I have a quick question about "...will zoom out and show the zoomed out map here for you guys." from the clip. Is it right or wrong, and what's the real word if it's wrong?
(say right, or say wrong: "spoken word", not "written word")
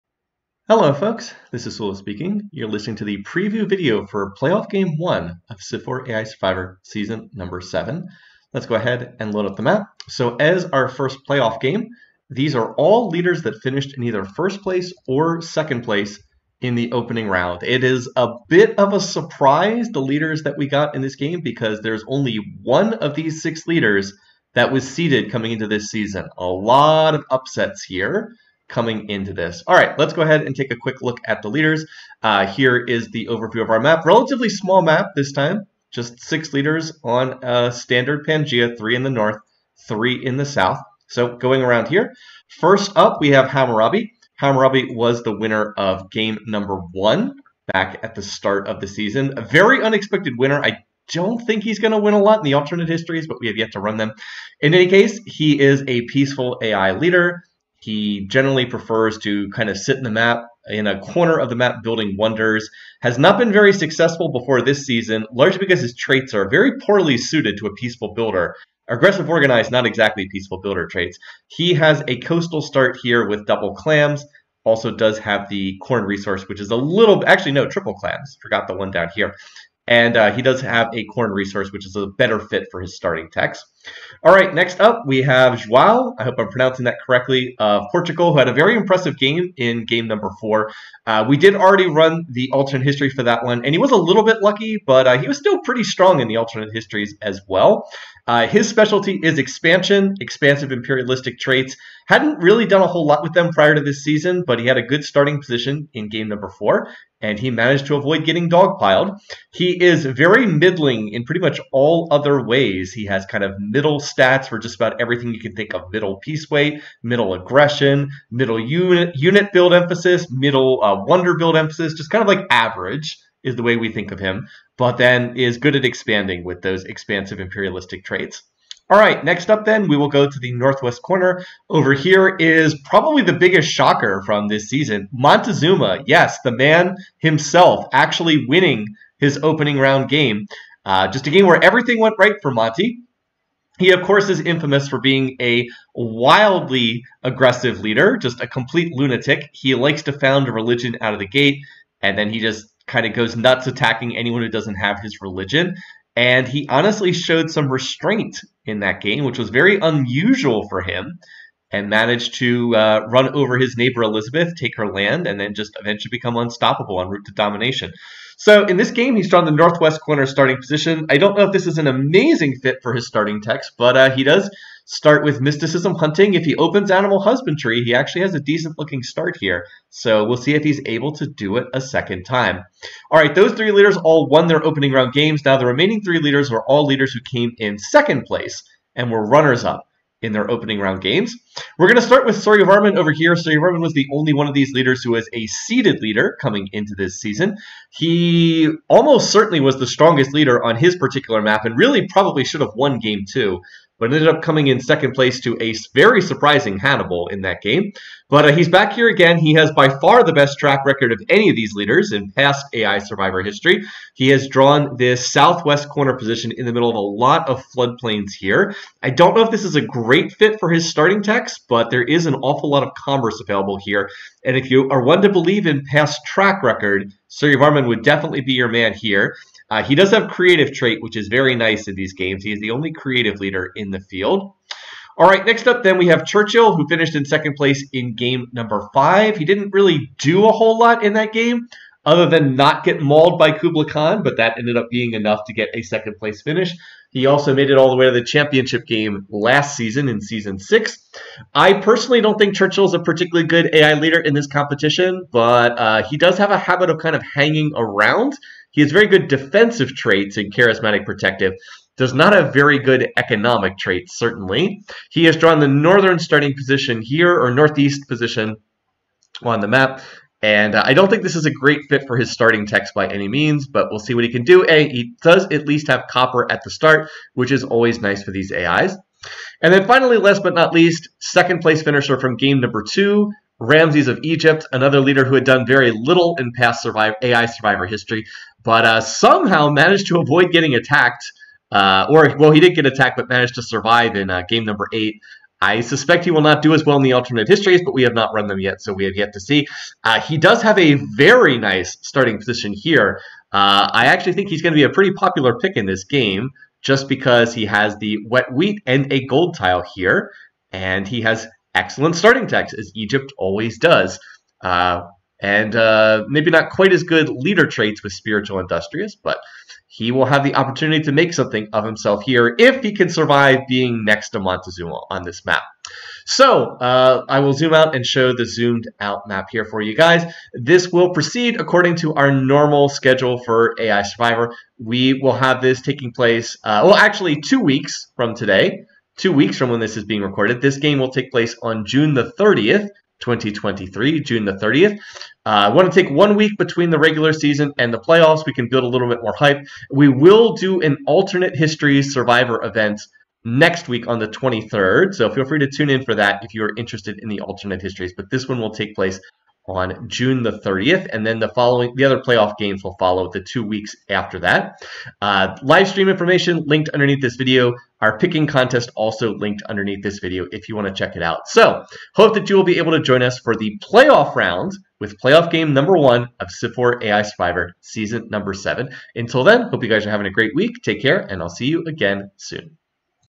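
right.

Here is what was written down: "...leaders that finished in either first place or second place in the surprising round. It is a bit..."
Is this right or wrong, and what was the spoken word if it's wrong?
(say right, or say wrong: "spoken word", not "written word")
wrong: "opening", not "surprising".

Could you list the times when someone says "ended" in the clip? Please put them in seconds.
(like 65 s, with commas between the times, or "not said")
204 s, 244 s.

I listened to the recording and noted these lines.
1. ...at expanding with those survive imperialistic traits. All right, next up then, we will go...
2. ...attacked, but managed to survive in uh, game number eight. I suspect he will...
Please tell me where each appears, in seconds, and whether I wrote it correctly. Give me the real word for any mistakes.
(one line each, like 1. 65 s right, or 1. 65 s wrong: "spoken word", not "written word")
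1. 125 s wrong: "expansive", not "survive"
2. 292 s right.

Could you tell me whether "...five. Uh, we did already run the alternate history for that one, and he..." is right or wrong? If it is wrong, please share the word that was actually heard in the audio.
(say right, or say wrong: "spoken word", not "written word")
wrong: "four", not "five".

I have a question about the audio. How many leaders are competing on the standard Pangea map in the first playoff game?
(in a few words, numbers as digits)
6.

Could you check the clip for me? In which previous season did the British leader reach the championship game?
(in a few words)
Season 6.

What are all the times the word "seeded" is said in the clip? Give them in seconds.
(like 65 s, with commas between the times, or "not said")
24 s, 195 s.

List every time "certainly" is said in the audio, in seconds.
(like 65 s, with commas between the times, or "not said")
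199 s, 264 s.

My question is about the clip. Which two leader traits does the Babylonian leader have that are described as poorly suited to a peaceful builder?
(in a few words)
Aggressive Organized.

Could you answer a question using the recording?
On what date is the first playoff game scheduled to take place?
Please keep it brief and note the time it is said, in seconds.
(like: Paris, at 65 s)
June 30, 2023, at 341 s.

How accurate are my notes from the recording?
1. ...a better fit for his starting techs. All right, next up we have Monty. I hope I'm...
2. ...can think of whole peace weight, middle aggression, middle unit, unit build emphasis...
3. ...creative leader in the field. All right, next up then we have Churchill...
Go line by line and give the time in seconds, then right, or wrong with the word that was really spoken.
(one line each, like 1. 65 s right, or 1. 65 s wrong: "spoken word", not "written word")
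1. 81 s wrong: "Joao", not "Monty"
2. 115 s wrong: "middle", not "whole"
3. 232 s right.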